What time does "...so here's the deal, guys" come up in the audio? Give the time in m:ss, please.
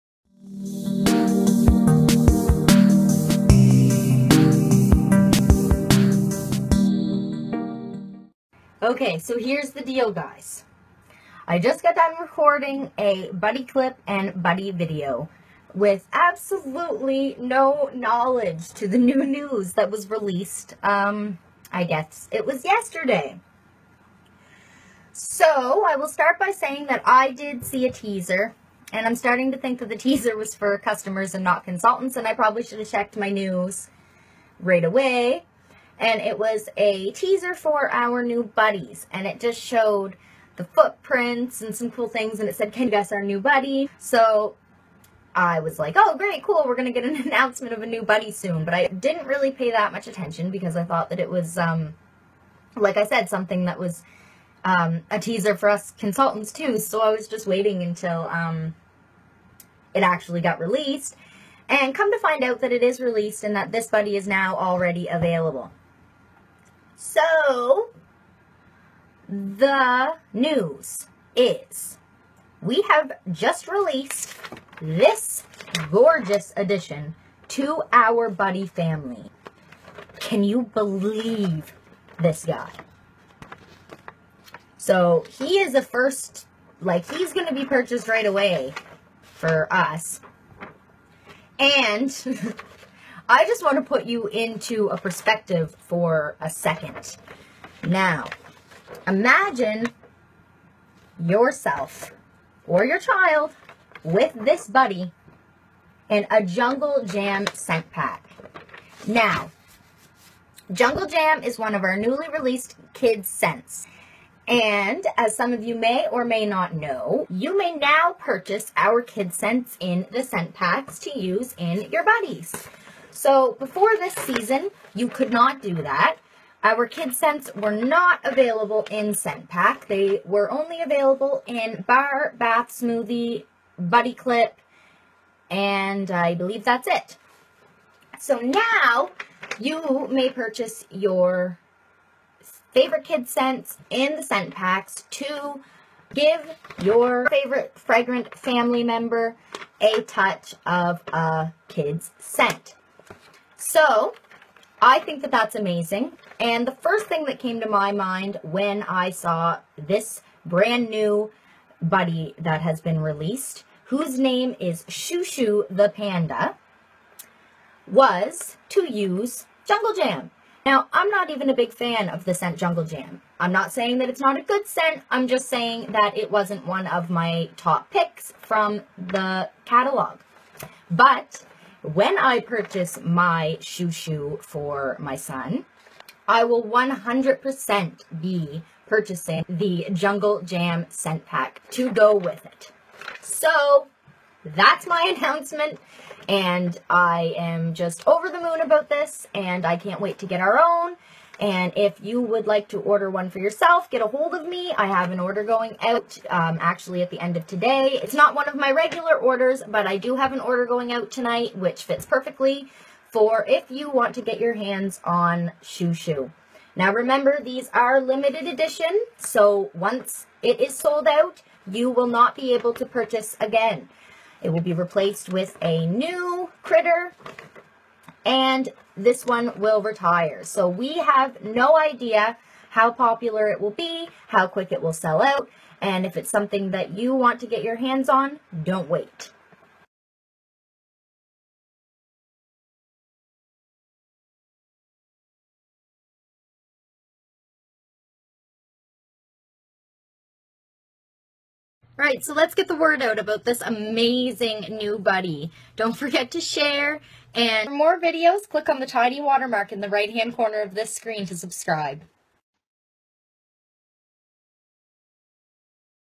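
0:09.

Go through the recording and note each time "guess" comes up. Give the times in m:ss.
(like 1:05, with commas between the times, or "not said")
0:21, 0:42.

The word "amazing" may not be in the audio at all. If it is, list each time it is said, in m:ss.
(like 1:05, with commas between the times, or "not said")
2:35, 4:13.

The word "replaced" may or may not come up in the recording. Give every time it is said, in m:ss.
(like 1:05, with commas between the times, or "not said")
3:44.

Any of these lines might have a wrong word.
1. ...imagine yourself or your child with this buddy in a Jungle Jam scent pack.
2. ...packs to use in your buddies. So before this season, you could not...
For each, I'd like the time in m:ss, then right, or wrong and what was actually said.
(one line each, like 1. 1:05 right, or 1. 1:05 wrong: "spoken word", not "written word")
1. 1:39 right
2. 2:00 right.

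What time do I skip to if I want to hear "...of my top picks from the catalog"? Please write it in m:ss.
2:56.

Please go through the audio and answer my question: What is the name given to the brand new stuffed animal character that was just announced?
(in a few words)
Shu Shu the Panda.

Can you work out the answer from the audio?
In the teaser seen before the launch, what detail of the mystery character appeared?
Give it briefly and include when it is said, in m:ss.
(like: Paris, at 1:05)
footprints, at 0:40.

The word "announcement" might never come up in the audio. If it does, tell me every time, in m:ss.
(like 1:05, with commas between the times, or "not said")
0:47, 3:15.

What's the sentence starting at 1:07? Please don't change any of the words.
So, the news is we have just released this gorgeous addition to our buddy family.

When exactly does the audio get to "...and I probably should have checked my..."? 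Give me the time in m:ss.
0:32.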